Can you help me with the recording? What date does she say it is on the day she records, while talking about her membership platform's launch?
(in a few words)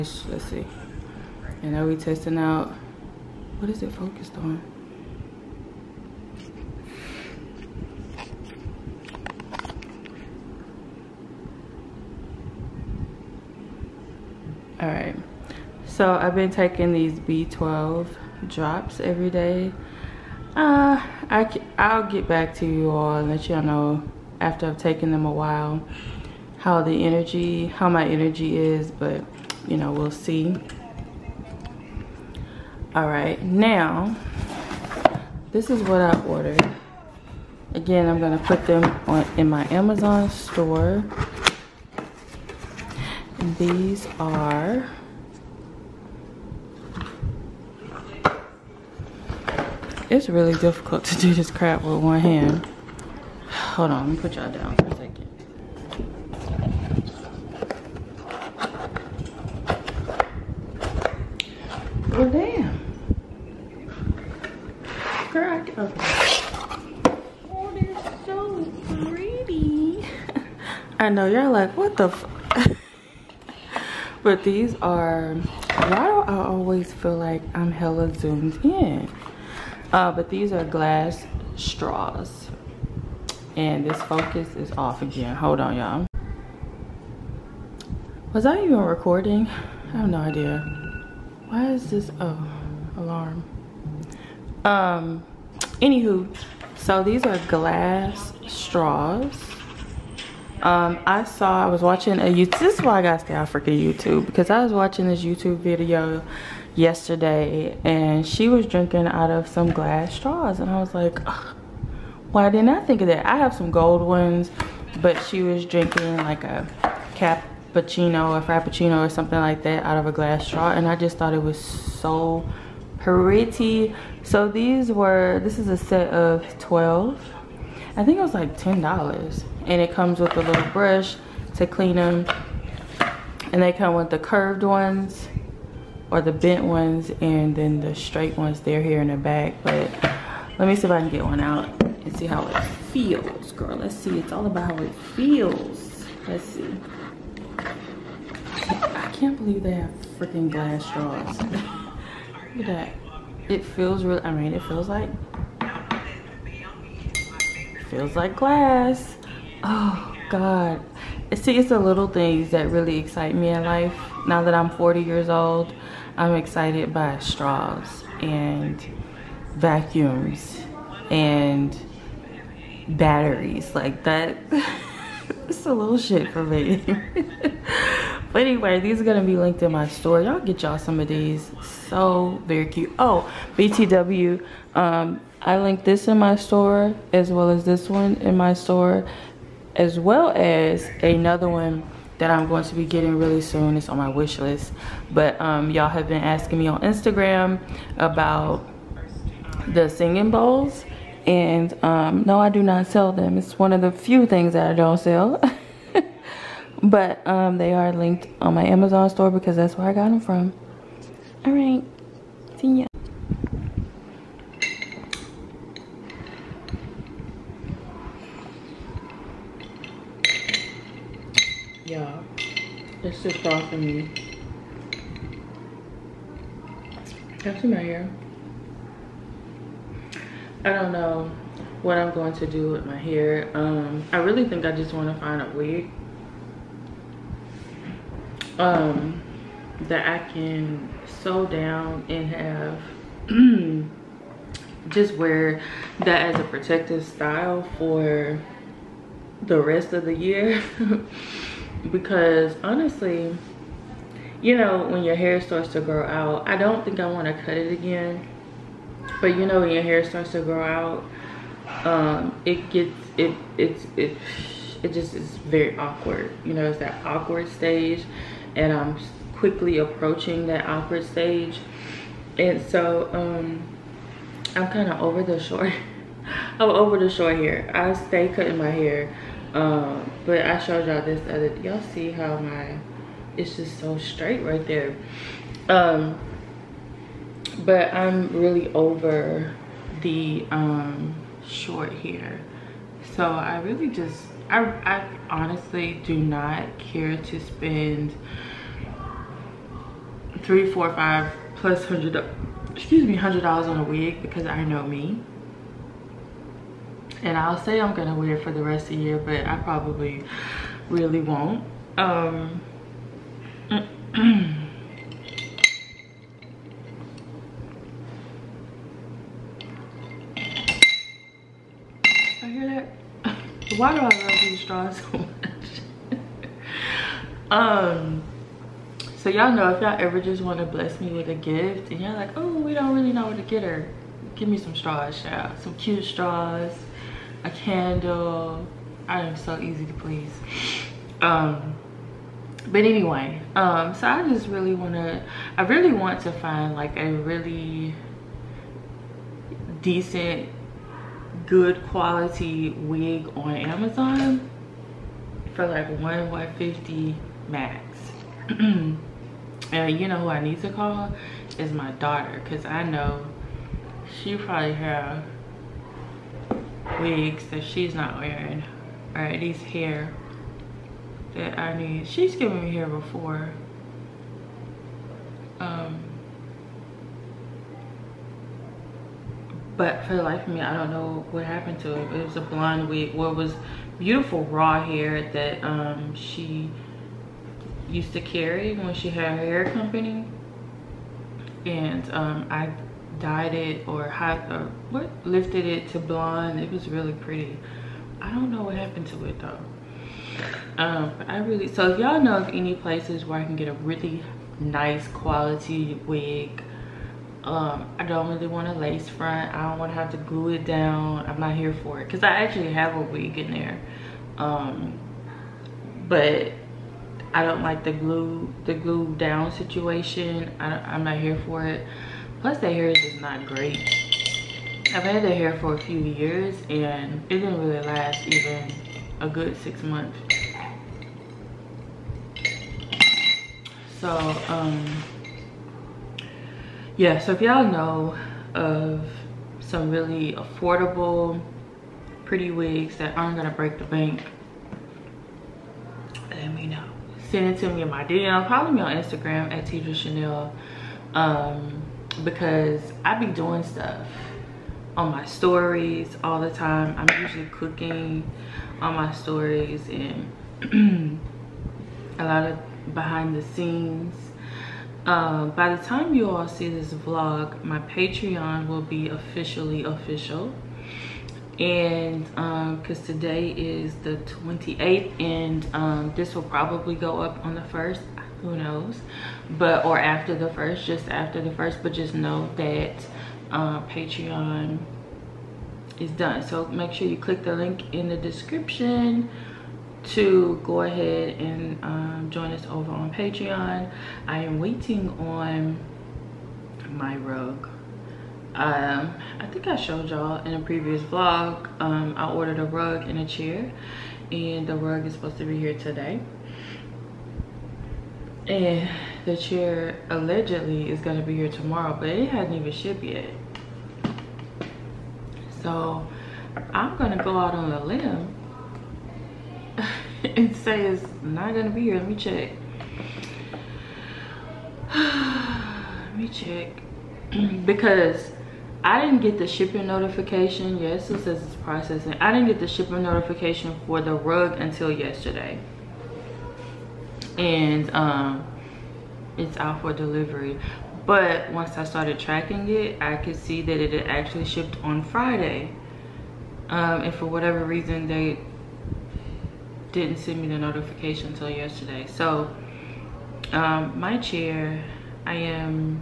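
28th.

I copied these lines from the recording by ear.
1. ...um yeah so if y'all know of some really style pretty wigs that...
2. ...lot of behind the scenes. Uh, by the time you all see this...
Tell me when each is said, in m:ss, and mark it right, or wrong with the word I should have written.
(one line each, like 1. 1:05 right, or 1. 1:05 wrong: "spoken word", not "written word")
1. 7:14 wrong: "affordable", not "style"
2. 7:42 right.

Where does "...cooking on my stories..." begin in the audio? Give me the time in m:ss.
7:37.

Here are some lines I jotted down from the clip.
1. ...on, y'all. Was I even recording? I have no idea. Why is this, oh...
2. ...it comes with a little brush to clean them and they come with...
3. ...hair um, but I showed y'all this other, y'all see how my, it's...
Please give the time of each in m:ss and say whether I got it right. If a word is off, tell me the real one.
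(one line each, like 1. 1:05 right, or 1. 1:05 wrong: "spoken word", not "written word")
1. 1:25 right
2. 2:09 right
3. 4:38 right.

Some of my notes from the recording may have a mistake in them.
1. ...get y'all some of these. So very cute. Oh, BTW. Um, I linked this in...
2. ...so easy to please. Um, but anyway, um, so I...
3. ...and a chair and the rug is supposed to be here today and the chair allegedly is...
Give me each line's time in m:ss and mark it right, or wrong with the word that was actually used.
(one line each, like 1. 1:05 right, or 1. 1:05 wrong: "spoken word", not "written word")
1. 3:00 right
2. 5:39 right
3. 8:23 right.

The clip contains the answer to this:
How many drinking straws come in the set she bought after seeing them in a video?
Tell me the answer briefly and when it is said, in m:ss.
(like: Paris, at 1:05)
12, at 2:06.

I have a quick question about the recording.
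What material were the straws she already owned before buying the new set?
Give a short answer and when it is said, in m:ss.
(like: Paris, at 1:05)
gold, at 1:53.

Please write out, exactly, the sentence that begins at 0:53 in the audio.
Hold on, let me put y'all down for a second.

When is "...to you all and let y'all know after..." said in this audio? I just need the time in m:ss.
0:22.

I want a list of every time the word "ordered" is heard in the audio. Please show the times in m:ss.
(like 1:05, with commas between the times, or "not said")
0:36, 8:22.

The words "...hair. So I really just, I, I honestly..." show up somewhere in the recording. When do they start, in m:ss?
4:51.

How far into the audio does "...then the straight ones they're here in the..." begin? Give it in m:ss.
2:17.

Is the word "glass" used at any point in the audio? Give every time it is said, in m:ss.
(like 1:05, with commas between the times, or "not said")
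1:20, 1:37, 1:49, 2:00, 2:30, 2:38.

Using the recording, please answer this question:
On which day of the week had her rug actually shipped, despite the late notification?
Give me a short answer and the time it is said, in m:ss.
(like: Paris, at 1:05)
Friday, at 9:05.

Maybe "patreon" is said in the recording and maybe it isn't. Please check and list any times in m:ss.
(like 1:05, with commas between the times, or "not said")
7:47, 8:03, 8:13.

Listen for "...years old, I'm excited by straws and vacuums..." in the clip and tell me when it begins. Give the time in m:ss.
2:45.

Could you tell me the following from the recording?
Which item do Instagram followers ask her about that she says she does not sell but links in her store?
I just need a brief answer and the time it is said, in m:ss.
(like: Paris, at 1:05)
singing bowls, at 3:19.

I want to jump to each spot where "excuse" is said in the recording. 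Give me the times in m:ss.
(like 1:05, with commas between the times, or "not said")
5:02.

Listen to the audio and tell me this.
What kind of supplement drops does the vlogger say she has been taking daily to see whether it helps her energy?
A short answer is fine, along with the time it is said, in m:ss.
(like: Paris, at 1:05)
B12, at 0:17.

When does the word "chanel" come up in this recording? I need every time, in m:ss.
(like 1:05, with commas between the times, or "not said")
7:29.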